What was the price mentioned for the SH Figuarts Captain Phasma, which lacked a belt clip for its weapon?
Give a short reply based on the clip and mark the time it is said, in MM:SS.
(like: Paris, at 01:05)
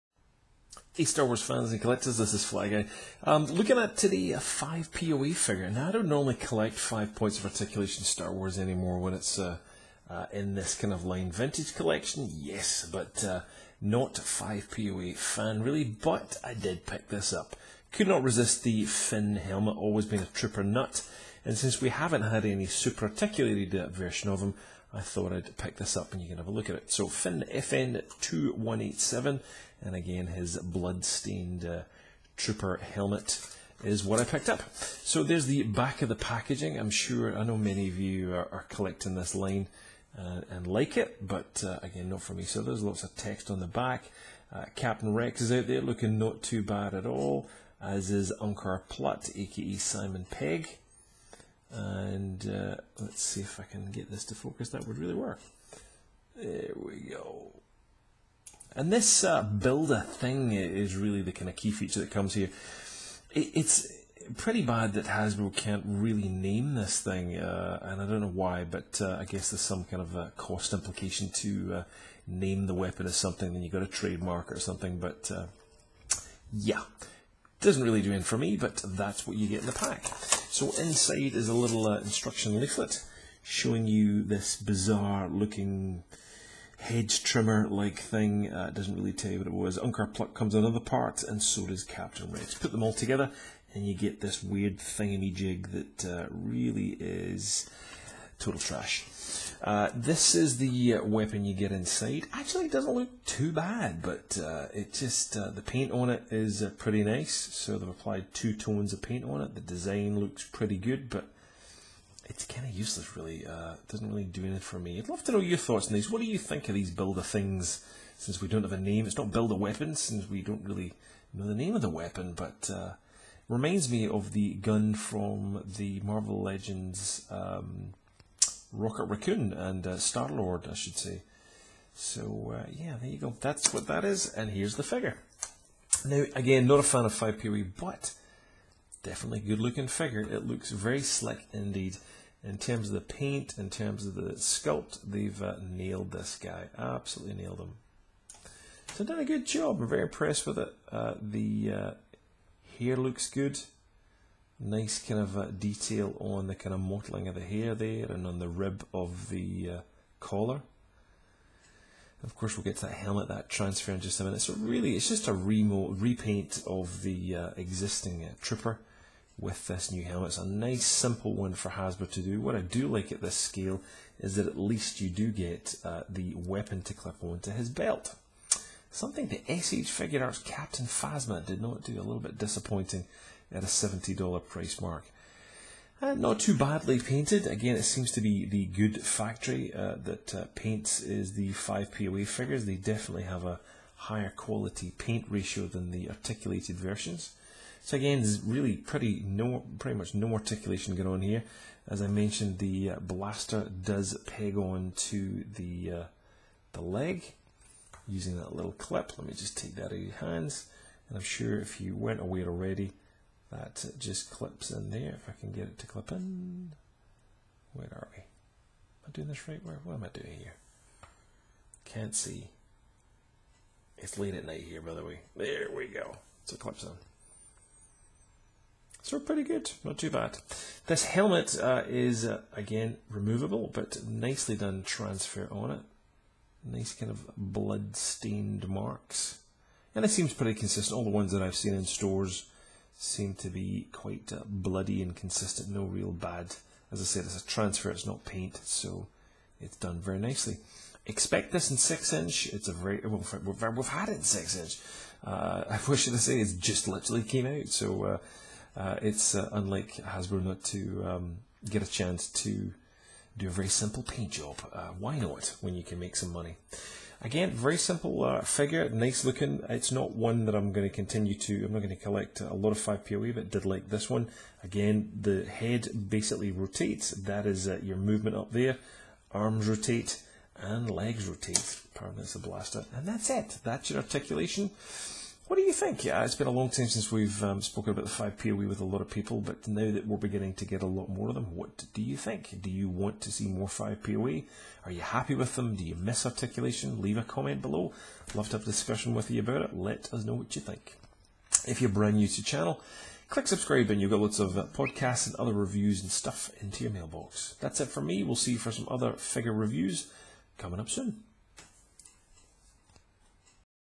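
$70, at 03:03.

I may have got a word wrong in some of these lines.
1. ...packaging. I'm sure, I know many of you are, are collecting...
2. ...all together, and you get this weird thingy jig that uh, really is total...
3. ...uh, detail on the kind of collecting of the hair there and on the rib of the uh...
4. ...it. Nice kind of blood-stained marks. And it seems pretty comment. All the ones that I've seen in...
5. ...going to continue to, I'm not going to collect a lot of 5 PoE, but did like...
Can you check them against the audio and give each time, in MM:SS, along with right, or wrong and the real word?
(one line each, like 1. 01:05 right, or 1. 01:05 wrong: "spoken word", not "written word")
1. 00:36 right
2. 01:32 right
3. 02:35 wrong: "mottling", not "collecting"
4. 03:55 wrong: "consistent", not "comment"
5. 04:30 right.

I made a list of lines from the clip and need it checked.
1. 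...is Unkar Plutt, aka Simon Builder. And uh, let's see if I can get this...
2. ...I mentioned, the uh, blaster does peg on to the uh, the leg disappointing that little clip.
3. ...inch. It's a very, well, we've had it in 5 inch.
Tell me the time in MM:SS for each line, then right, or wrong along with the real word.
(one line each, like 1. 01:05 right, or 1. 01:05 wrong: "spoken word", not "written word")
1. 00:48 wrong: "Pegg", not "Builder"
2. 03:22 wrong: "using", not "disappointing"
3. 04:12 wrong: "6", not "5".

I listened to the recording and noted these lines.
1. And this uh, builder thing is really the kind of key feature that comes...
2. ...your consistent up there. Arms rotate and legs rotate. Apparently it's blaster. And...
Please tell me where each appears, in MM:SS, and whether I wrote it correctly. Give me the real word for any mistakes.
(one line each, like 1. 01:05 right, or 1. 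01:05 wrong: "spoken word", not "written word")
1. 00:58 right
2. 04:37 wrong: "movement", not "consistent".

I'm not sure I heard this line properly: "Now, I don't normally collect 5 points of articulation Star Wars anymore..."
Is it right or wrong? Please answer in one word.
right.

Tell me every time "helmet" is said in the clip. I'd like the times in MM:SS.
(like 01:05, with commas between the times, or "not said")
00:19, 00:32, 02:42, 02:50, 03:51.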